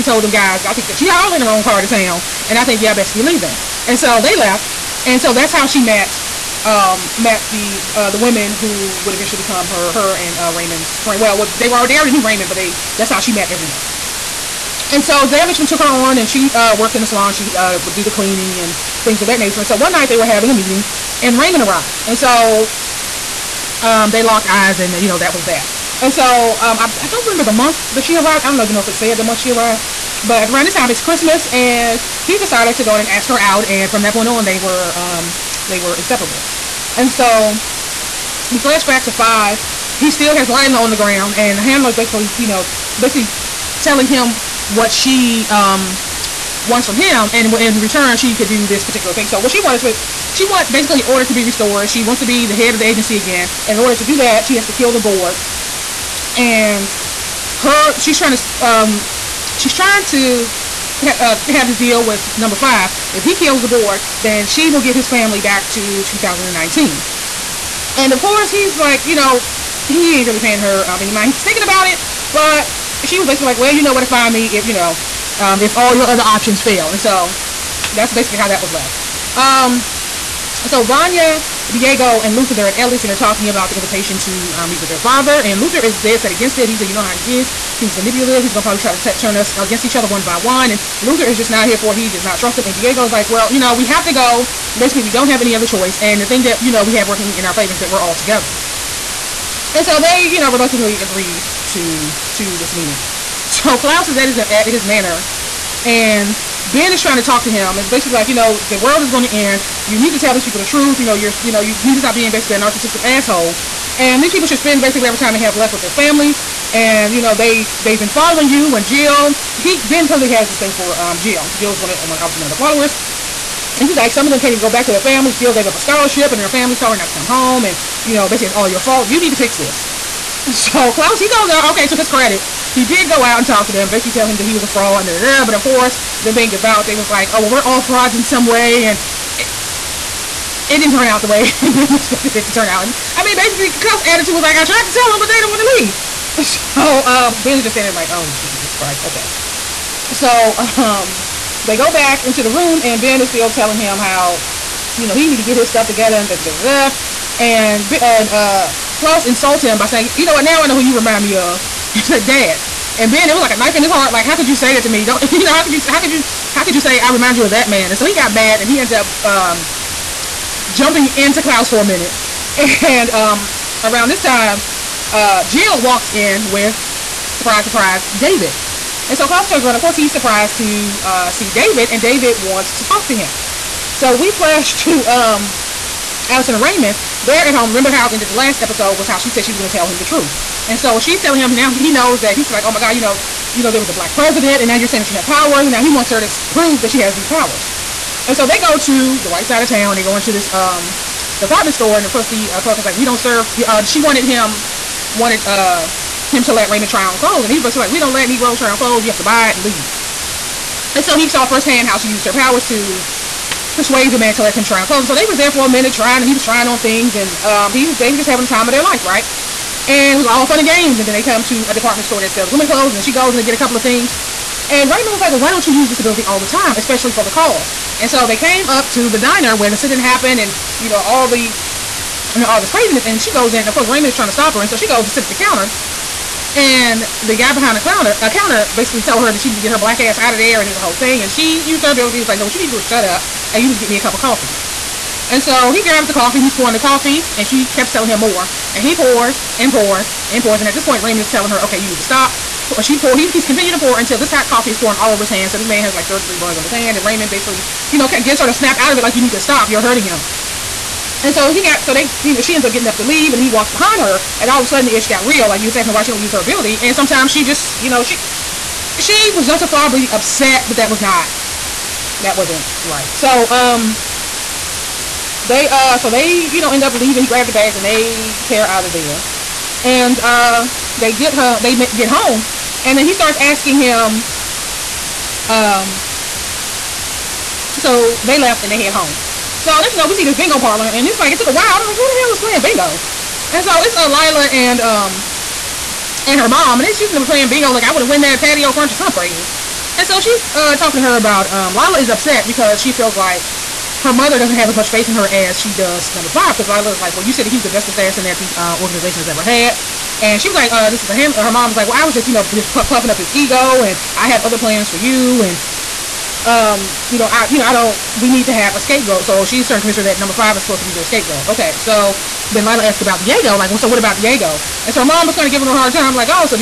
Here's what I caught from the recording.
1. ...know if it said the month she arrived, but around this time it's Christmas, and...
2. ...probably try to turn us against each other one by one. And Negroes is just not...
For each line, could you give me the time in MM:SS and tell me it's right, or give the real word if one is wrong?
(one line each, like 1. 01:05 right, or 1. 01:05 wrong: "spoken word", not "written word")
1. 00:28 right
2. 01:28 wrong: "Luther", not "Negroes".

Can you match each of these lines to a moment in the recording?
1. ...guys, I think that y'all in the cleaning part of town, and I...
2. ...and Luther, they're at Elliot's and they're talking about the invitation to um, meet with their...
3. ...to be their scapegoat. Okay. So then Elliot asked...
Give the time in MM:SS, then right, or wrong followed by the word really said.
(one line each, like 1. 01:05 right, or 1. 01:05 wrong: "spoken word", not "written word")
1. 00:00 wrong: "wrong", not "cleaning"
2. 01:22 right
3. 05:20 wrong: "Lila", not "Elliot".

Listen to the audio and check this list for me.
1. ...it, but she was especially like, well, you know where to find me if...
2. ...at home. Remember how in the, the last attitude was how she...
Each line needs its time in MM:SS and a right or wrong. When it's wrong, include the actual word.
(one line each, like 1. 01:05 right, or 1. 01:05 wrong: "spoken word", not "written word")
1. 01:11 wrong: "basically", not "especially"
2. 03:07 wrong: "episode", not "attitude".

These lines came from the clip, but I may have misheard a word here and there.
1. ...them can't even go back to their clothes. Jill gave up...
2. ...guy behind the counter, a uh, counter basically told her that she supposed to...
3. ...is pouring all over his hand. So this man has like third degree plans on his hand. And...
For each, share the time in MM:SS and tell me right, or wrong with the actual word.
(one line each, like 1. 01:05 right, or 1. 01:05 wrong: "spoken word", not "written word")
1. 02:04 wrong: "families", not "clothes"
2. 03:57 wrong: "needed", not "supposed"
3. 04:14 wrong: "burns", not "plans".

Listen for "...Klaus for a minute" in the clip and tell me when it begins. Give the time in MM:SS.
02:51.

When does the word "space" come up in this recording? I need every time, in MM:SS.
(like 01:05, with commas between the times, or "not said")
not said.